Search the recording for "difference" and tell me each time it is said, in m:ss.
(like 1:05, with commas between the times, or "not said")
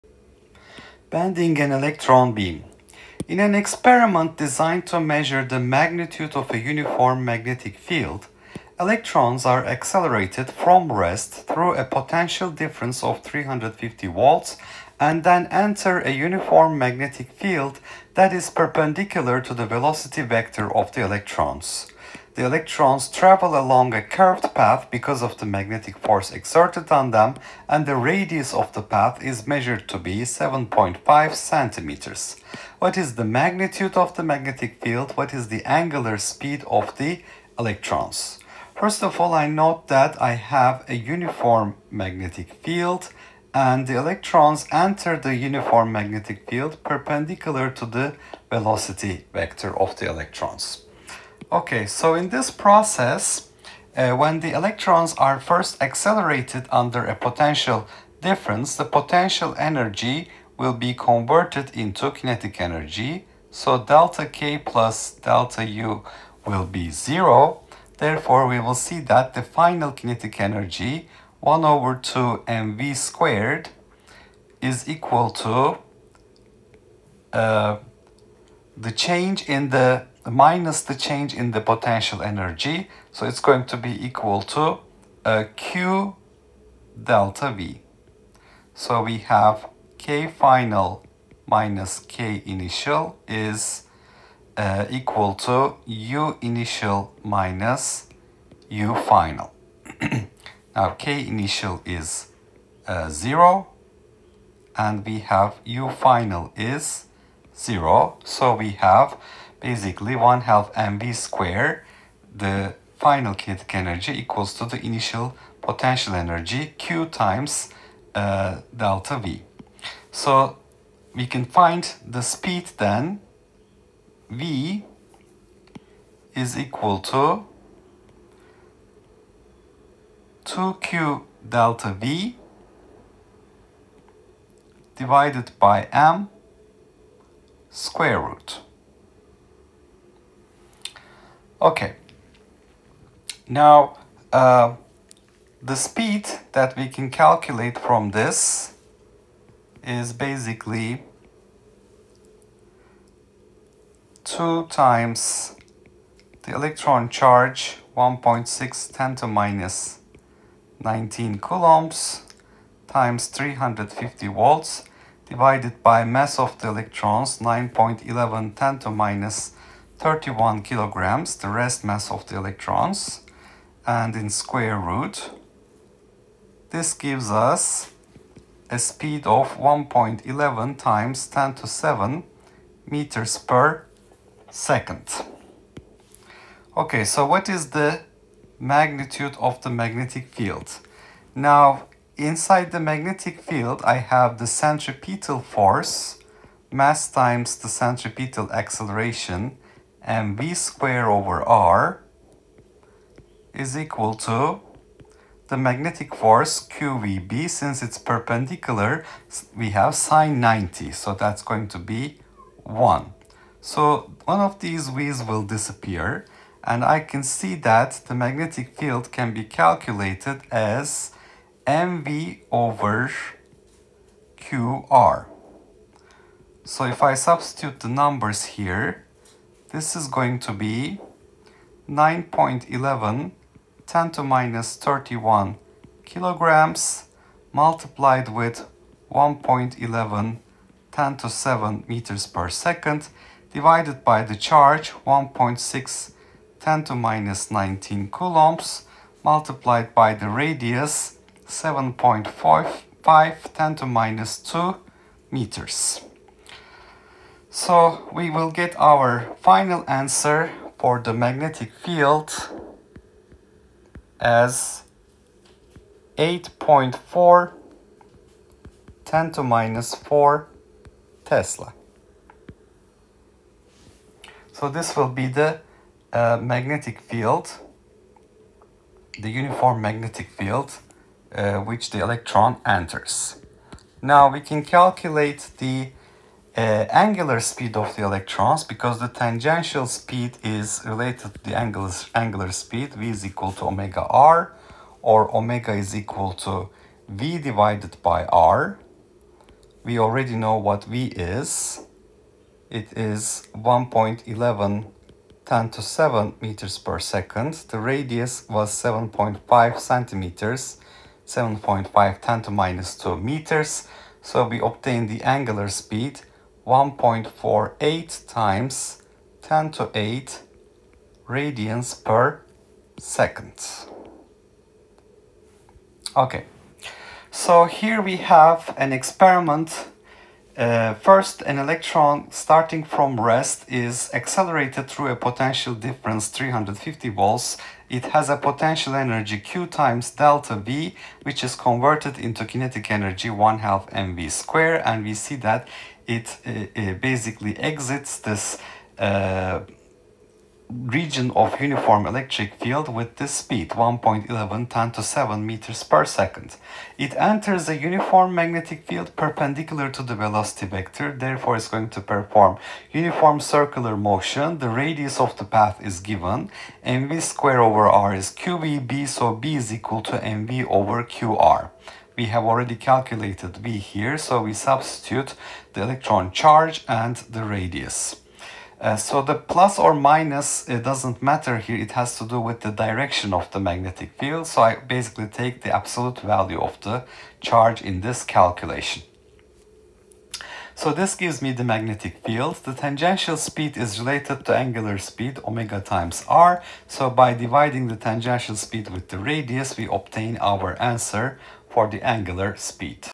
0:12, 0:58, 5:35.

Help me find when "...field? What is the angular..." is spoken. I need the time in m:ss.
0:34.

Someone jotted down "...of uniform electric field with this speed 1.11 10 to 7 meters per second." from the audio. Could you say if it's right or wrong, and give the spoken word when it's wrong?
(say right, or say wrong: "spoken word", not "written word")
right.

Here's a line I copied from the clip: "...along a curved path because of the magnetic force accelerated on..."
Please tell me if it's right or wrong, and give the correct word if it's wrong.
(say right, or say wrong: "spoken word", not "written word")
wrong: "exerted", not "accelerated".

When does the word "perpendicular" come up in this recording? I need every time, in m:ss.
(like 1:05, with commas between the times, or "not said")
0:18, 0:46, 3:27, 5:59.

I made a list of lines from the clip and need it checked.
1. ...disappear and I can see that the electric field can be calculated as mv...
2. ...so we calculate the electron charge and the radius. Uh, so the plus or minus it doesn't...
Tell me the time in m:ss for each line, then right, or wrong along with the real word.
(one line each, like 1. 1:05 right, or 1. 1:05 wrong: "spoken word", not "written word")
1. 3:35 wrong: "magnetic", not "electric"
2. 6:14 wrong: "substitute", not "calculate".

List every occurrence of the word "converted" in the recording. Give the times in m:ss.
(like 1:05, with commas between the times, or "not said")
1:00, 5:41.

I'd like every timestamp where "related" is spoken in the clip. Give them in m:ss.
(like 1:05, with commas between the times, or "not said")
4:50, 6:34.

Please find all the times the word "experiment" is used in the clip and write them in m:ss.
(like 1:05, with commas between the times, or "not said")
0:03, 5:28.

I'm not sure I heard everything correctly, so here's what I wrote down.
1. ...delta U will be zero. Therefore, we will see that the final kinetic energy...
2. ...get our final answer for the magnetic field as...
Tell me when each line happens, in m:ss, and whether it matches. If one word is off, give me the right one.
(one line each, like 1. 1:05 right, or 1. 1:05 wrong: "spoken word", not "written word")
1. 1:05 right
2. 4:18 right.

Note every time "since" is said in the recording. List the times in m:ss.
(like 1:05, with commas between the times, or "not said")
3:27.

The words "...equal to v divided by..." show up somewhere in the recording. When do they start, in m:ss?
4:55.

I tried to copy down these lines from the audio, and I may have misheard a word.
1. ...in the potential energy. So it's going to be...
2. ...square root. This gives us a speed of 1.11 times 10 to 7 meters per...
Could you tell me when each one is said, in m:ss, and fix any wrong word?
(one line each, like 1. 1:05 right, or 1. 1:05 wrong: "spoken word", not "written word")
1. 1:21 right
2. 2:54 right.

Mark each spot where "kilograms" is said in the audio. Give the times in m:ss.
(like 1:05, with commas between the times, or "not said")
2:50, 3:56.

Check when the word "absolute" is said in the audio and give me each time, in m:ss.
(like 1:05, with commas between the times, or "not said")
6:25.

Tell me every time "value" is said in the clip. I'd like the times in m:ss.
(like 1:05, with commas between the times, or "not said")
6:26.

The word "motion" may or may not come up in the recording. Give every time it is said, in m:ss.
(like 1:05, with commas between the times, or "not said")
6:03.